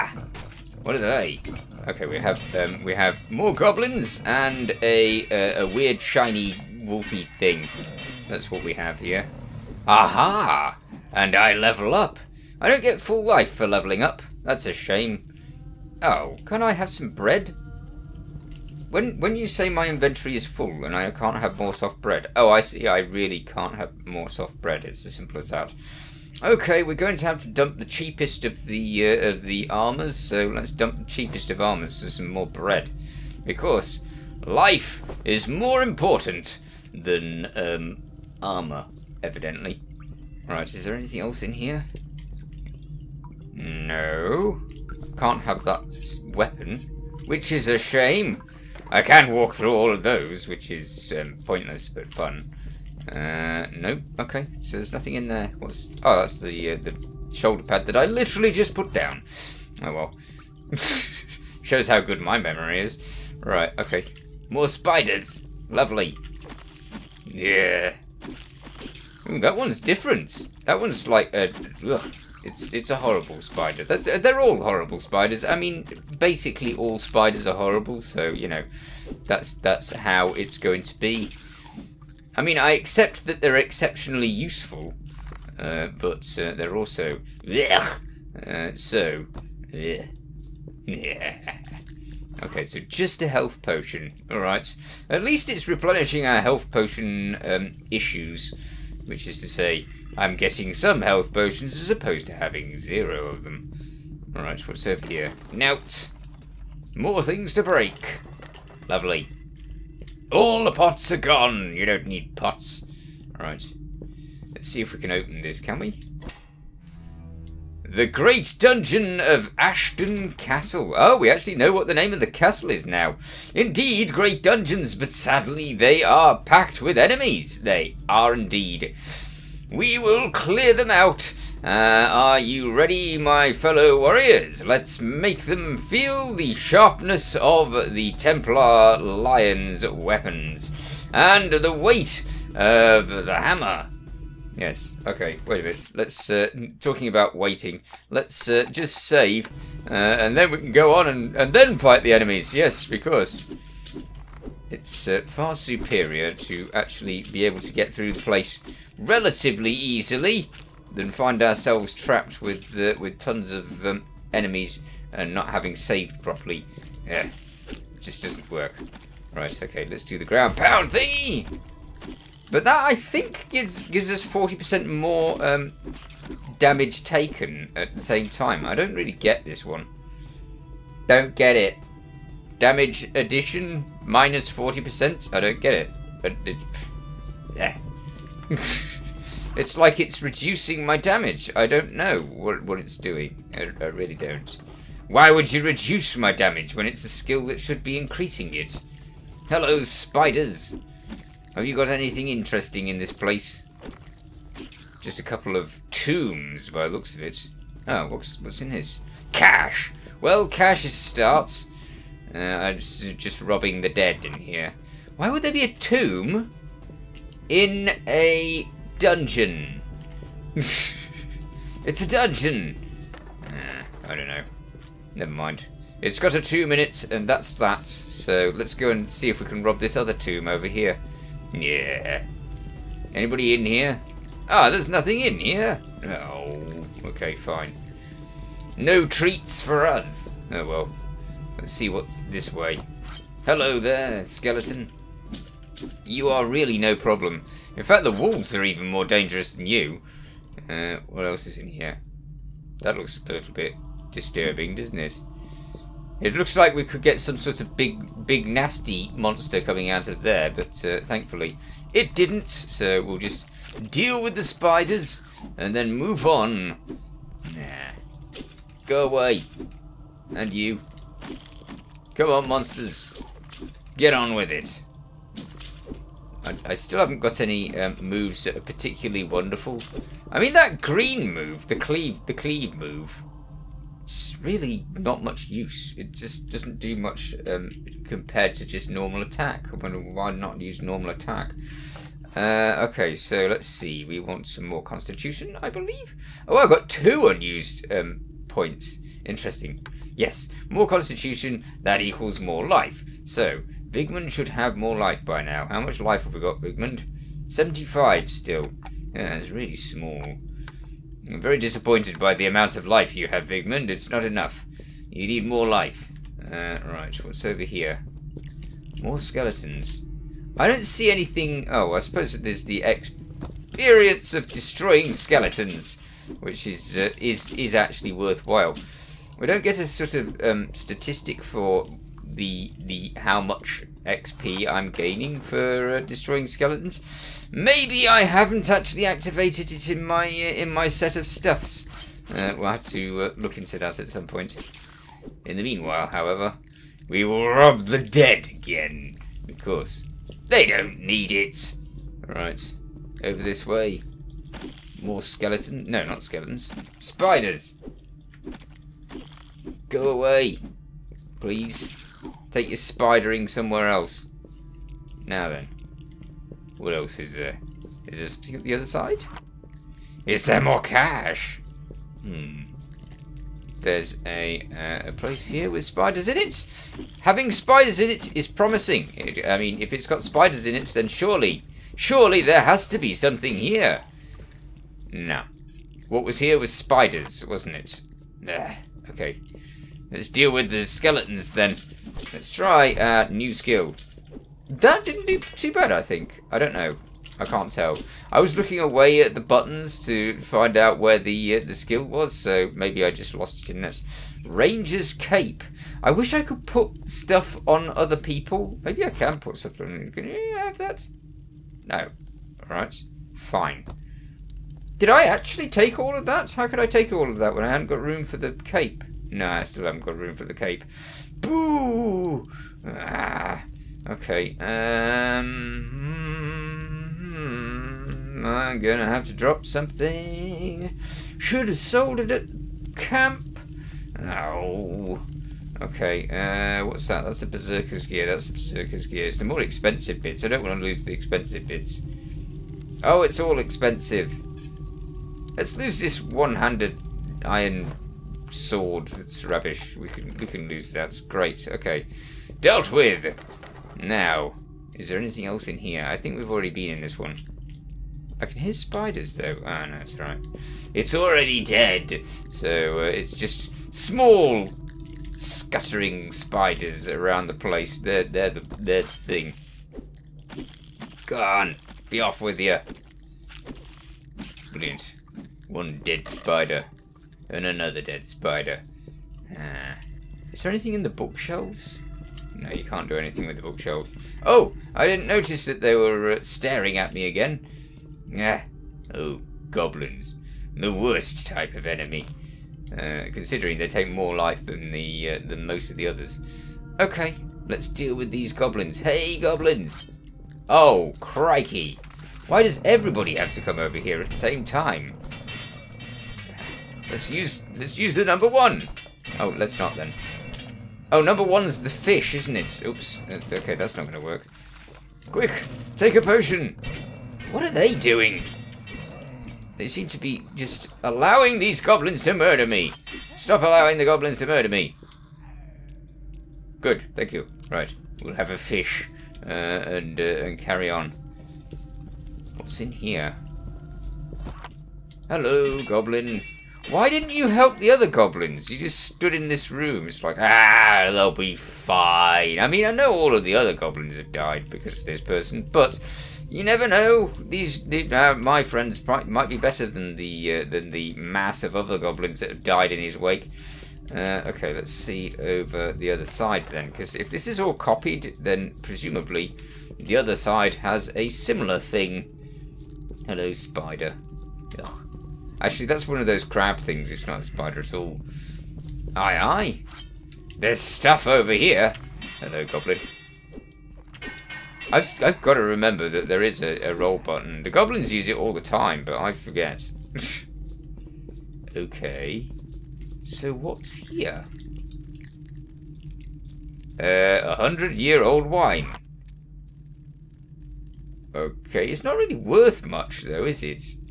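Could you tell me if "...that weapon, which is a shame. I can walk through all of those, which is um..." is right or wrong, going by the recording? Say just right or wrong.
right.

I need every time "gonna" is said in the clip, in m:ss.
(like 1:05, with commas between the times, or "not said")
7:08.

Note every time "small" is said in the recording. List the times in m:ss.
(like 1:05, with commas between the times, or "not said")
5:09, 7:43.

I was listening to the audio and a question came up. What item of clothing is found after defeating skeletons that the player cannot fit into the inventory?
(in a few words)
Ranger's Cape.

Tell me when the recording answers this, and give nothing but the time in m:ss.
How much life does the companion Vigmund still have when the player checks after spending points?
5:07.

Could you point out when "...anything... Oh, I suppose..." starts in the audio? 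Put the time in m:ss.
5:21.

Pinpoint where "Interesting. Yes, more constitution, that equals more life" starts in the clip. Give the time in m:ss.
4:59.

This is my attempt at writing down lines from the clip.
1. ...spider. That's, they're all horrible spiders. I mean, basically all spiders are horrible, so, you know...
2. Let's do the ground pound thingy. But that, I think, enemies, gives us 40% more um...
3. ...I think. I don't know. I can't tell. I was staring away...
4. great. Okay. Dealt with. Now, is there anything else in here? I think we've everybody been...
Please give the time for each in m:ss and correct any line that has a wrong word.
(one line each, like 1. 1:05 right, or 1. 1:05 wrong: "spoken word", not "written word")
1. 1:13 right
2. 2:49 wrong: "gives", not "enemies"
3. 6:35 wrong: "looking", not "staring"
4. 7:31 wrong: "already", not "everybody".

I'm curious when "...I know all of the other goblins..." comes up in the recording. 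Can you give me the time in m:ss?
9:02.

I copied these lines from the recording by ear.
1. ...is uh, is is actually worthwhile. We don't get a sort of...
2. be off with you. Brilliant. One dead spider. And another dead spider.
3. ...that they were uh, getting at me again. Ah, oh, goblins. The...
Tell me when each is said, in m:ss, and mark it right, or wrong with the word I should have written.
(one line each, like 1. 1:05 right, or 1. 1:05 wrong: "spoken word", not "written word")
1. 5:26 right
2. 7:52 right
3. 8:05 wrong: "staring", not "getting".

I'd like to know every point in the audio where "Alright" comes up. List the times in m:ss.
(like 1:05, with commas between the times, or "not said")
1:34, 1:44, 1:53, 6:52.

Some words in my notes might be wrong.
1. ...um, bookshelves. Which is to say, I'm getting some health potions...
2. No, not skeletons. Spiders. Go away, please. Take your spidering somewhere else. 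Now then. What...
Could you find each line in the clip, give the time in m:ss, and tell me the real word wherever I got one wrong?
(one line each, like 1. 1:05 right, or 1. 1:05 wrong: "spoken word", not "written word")
1. 1:37 wrong: "issues", not "bookshelves"
2. 5:55 right.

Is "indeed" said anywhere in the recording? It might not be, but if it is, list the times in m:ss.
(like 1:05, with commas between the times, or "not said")
2:03, 2:08.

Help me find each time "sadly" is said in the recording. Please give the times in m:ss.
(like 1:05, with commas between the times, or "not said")
2:05.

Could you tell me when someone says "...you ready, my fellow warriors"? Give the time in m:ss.
2:12.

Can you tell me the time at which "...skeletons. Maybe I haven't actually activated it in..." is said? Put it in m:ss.
5:36.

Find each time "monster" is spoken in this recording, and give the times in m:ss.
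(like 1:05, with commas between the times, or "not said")
4:19, 4:32.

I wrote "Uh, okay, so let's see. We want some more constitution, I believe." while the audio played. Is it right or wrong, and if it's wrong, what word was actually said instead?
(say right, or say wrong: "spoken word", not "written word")
right.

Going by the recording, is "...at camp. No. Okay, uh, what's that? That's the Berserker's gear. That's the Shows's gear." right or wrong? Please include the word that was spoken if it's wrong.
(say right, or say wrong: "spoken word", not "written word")
wrong: "Berserker", not "Shows".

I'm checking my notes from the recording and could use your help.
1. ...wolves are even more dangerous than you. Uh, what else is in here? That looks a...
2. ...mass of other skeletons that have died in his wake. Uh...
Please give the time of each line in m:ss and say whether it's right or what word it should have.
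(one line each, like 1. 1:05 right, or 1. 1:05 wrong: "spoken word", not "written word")
1. 4:08 right
2. 9:11 wrong: "goblins", not "skeletons".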